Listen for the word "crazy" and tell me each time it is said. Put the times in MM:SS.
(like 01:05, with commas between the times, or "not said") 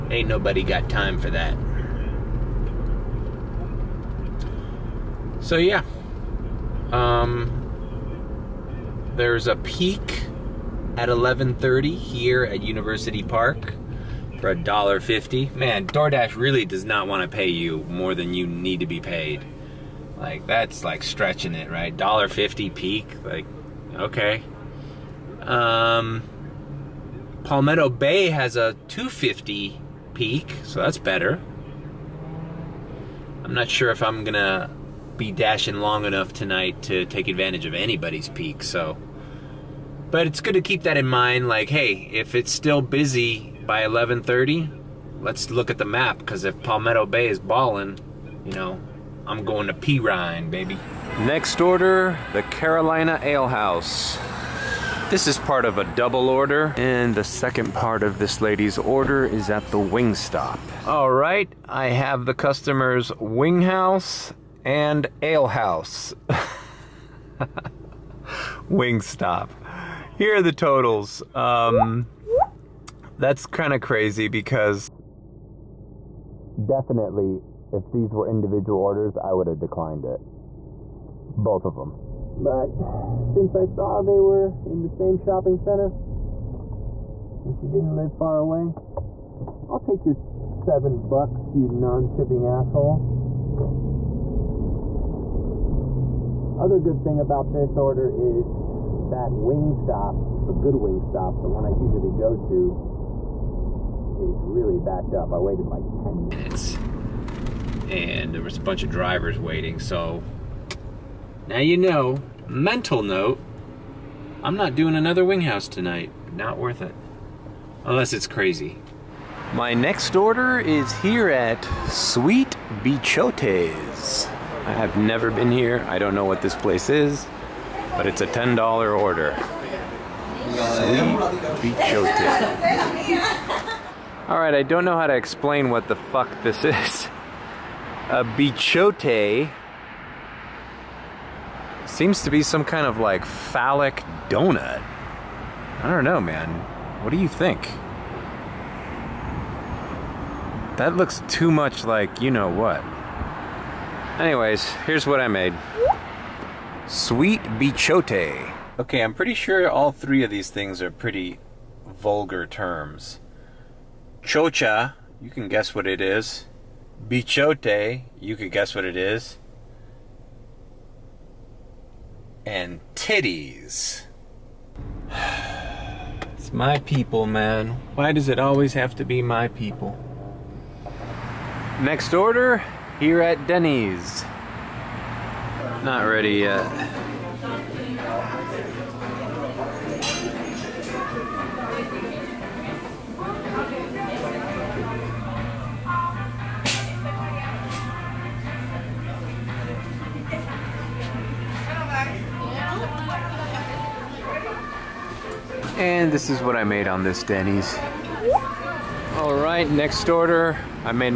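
01:13, 01:58.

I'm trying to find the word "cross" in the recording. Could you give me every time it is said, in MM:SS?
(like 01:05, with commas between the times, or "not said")
not said.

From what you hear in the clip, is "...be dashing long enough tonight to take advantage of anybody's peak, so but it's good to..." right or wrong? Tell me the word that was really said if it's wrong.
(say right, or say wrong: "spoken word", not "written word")
right.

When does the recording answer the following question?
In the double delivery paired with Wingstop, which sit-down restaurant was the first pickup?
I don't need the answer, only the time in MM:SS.
00:52.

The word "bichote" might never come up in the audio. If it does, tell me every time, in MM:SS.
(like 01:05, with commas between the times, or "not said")
02:02, 02:18, 02:37, 02:47.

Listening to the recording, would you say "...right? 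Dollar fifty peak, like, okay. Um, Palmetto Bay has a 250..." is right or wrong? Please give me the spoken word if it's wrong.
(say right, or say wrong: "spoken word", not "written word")
right.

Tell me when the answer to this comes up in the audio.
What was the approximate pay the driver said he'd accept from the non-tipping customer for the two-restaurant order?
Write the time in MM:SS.
01:30.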